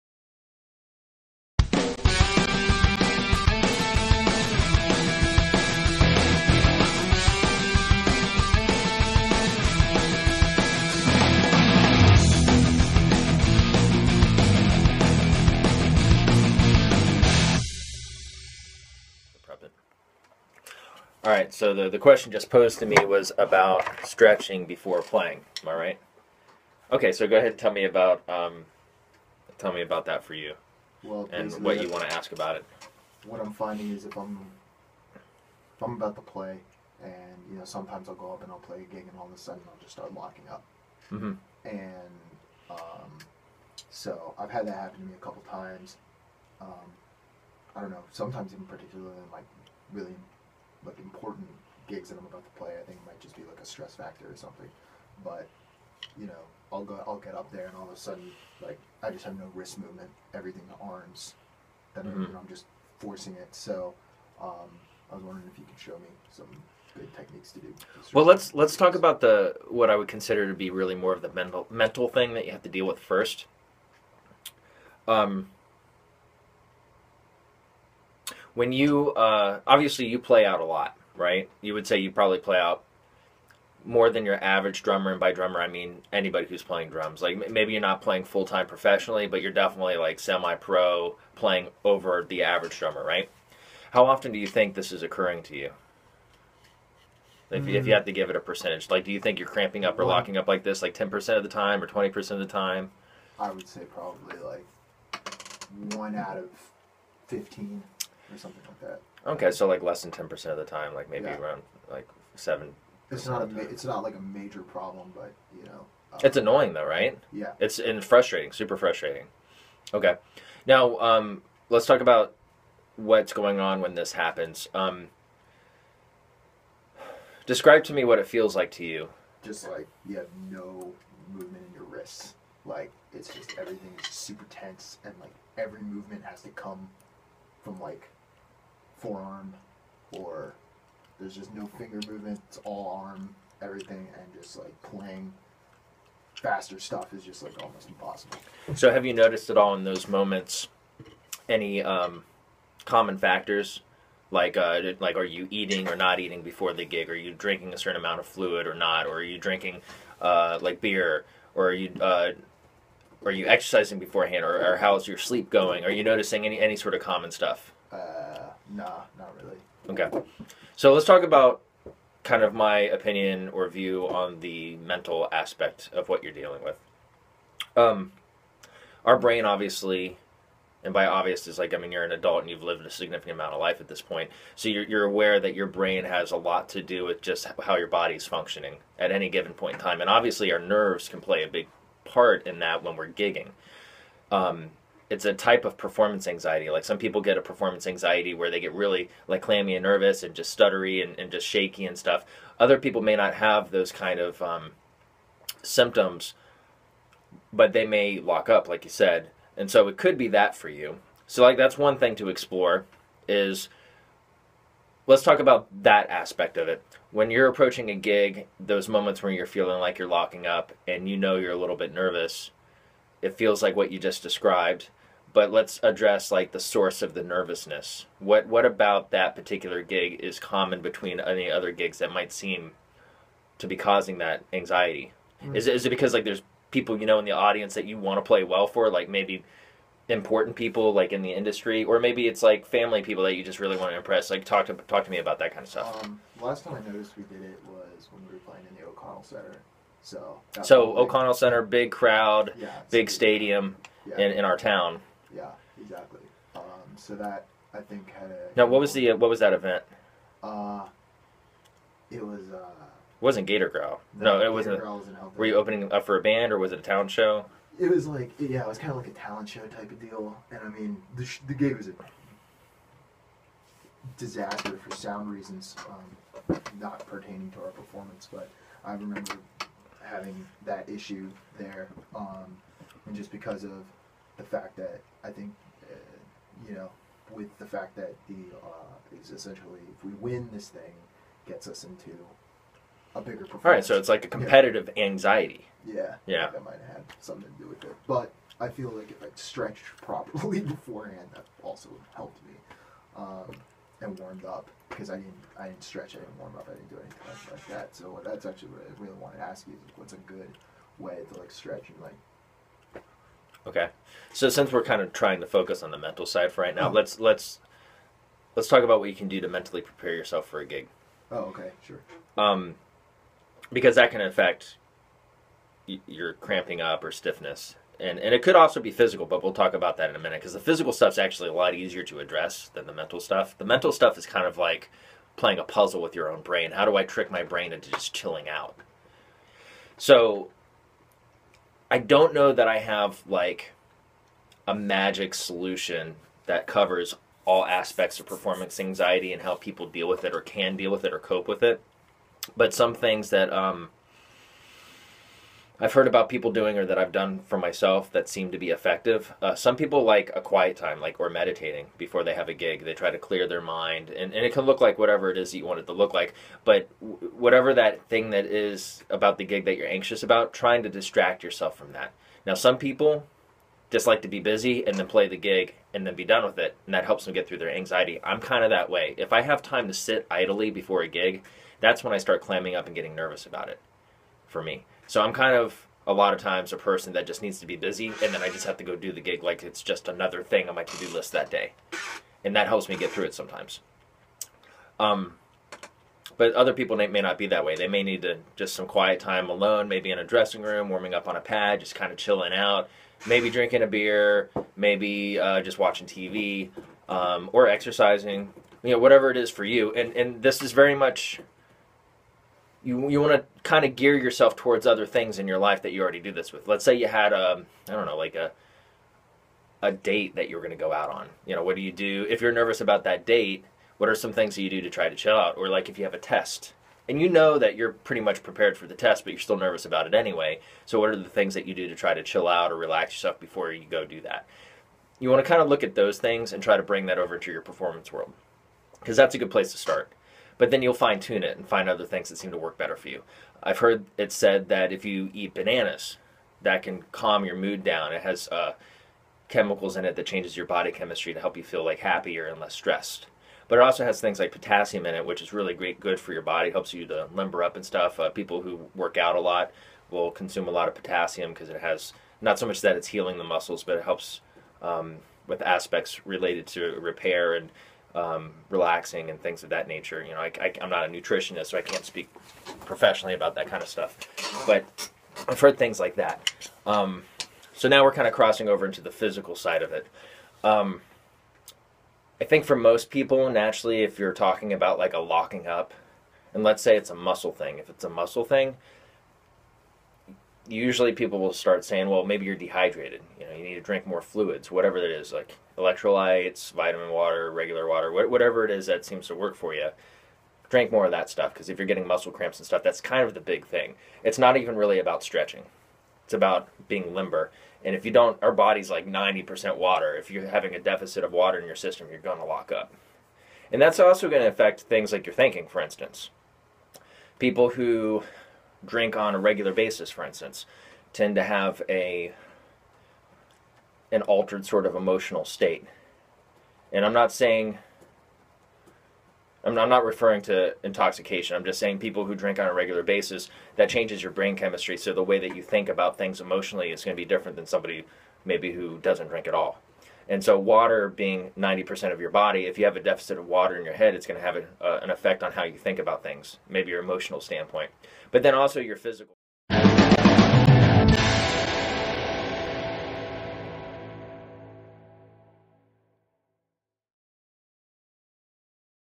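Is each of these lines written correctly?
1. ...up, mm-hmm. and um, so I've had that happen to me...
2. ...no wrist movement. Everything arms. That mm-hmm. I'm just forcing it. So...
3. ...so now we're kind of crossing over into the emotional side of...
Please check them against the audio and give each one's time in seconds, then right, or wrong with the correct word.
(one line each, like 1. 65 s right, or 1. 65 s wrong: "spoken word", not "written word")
1. 40 s right
2. 59 s right
3. 477 s wrong: "physical", not "emotional".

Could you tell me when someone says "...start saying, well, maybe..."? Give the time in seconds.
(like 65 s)
491 s.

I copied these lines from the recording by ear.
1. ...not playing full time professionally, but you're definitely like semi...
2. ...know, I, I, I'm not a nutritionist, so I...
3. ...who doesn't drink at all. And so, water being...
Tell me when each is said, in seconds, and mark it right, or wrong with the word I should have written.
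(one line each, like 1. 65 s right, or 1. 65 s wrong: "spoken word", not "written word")
1. 87 s right
2. 470 s right
3. 538 s right.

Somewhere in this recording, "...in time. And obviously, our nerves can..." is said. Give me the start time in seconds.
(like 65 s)
189 s.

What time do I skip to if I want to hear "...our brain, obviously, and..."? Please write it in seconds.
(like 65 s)
179 s.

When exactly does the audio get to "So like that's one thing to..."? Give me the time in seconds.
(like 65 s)
211 s.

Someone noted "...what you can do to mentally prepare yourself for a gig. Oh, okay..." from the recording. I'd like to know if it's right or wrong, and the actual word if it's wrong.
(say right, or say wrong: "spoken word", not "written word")
right.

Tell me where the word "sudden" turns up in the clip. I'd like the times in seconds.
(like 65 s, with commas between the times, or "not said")
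39 s, 57 s.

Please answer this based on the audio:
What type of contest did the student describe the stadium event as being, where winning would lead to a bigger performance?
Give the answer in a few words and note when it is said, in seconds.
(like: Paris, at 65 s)
Talent show, at 269 s.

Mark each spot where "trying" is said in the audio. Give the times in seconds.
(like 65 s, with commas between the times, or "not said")
315 s, 370 s.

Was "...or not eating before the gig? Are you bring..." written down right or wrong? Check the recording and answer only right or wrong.
wrong.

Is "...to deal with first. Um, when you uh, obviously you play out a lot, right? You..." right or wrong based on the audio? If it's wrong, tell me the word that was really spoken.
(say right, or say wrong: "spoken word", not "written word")
right.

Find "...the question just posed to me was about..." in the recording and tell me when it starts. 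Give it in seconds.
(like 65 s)
21 s.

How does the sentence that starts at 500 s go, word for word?
Drink more of that stuff because if you're getting muscle cramps and stuff, that's kind of the big thing.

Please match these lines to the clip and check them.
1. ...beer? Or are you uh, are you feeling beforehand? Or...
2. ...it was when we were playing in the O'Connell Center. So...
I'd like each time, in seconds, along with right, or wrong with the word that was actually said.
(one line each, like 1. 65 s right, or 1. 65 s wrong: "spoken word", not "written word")
1. 160 s wrong: "exercising", not "feeling"
2. 247 s right.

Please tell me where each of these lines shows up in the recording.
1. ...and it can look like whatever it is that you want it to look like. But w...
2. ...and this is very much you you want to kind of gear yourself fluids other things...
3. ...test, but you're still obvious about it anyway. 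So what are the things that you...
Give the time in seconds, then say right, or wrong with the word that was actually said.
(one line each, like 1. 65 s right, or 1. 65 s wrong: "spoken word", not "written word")
1. 364 s right
2. 410 s wrong: "towards", not "fluids"
3. 428 s wrong: "nervous", not "obvious".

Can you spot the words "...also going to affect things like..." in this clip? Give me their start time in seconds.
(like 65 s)
513 s.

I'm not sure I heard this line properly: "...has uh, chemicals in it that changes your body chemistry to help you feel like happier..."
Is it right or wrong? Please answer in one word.
right.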